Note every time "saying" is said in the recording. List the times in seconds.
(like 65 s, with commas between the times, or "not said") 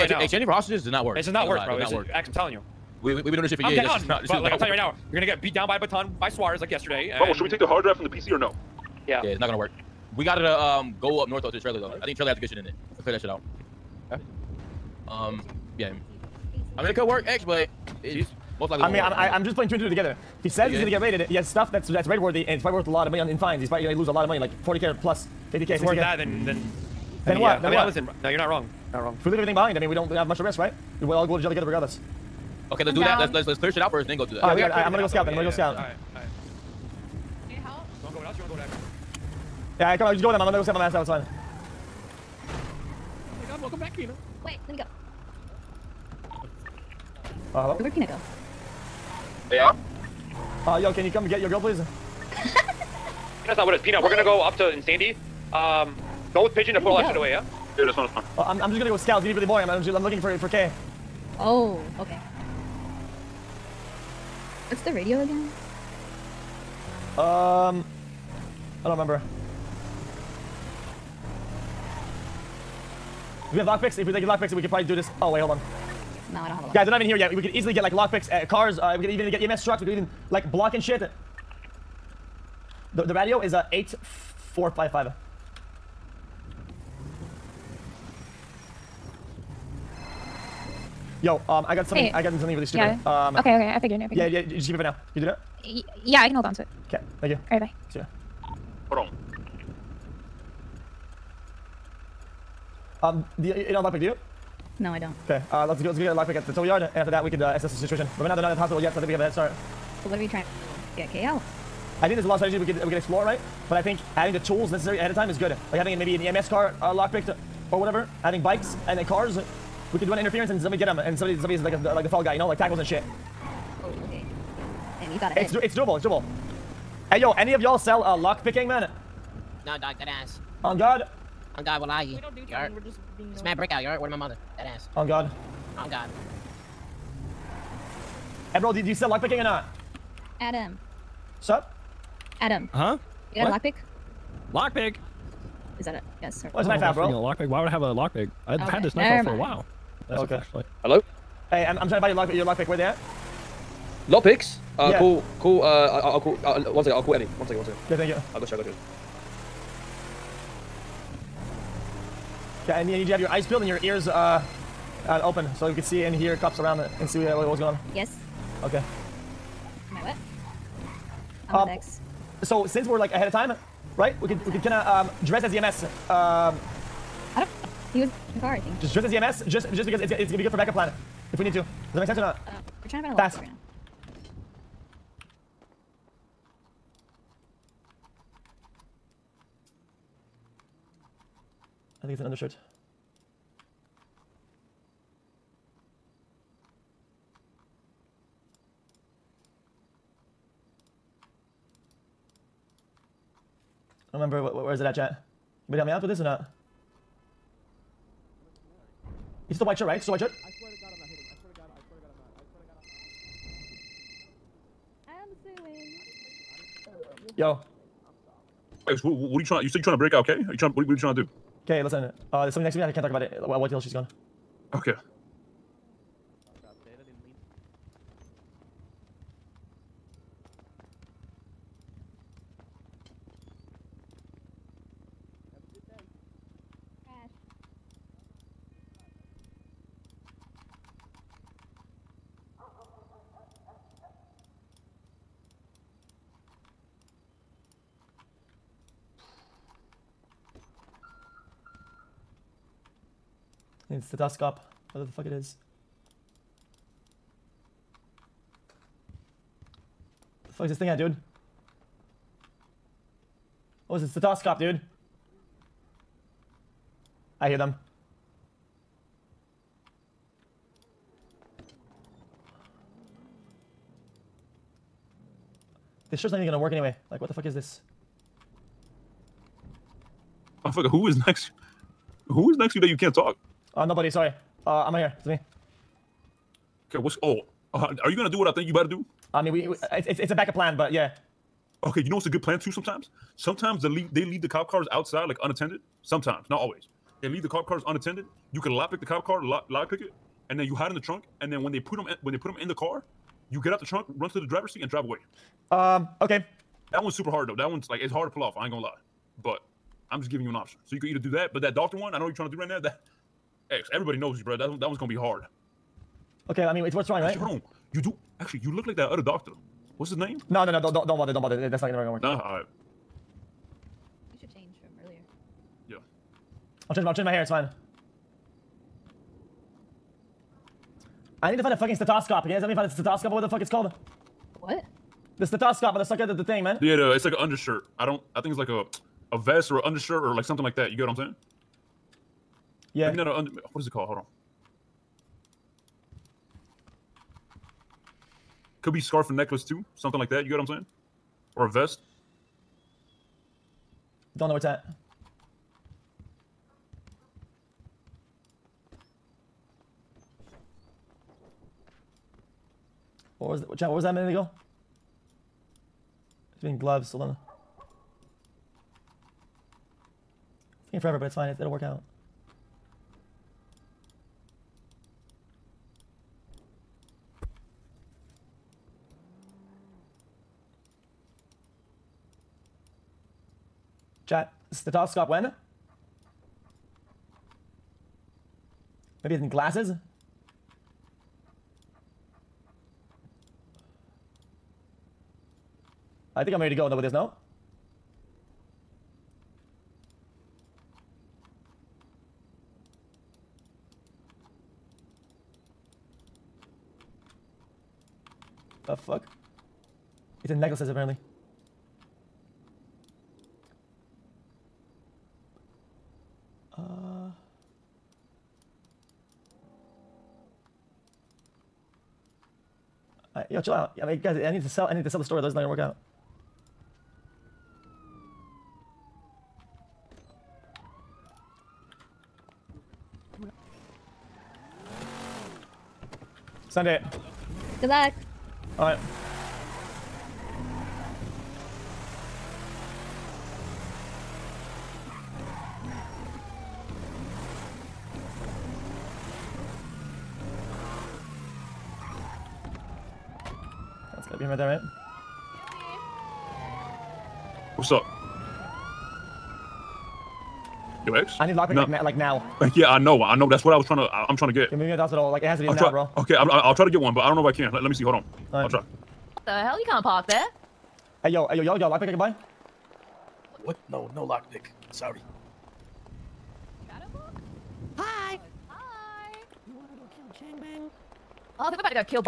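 341 s, 350 s.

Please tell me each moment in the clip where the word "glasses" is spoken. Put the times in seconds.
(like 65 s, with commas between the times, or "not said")
389 s.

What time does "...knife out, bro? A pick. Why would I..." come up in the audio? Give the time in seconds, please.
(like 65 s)
146 s.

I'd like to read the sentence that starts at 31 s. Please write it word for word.
We'll all go to jail together regardless.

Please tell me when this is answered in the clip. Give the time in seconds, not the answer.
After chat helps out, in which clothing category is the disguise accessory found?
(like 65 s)
410 s.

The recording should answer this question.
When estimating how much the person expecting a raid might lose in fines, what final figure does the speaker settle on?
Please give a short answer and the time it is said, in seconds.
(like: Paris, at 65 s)
60K, at 25 s.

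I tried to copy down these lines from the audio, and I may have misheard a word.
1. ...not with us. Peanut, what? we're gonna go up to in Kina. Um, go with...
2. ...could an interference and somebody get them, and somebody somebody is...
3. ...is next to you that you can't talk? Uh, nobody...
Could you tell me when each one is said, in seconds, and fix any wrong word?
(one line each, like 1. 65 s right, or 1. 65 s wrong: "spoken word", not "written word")
1. 53 s wrong: "Sandy", not "Kina"
2. 119 s right
3. 282 s right.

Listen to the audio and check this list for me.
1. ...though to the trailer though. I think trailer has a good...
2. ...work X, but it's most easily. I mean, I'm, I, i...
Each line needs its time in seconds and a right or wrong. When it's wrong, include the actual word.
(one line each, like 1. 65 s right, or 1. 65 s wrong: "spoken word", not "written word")
1. 11 s right
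2. 17 s wrong: "likely", not "easily".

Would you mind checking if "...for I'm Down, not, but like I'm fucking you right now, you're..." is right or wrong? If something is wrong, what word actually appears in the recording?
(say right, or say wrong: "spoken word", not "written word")
wrong: "telling", not "fucking".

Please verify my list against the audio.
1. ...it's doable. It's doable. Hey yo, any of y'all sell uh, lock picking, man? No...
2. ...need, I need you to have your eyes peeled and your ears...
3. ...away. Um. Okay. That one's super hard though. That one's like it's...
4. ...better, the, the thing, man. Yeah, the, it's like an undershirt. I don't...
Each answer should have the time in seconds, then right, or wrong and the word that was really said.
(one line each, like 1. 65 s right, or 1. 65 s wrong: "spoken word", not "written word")
1. 125 s right
2. 162 s right
3. 305 s right
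4. 335 s wrong: "motherfucker", not "better".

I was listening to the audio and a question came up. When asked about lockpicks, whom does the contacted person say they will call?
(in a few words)
Eddie.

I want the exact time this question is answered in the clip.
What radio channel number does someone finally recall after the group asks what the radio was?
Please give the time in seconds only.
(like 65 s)
83 s.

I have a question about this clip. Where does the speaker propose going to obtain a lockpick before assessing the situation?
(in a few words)
the tow yard.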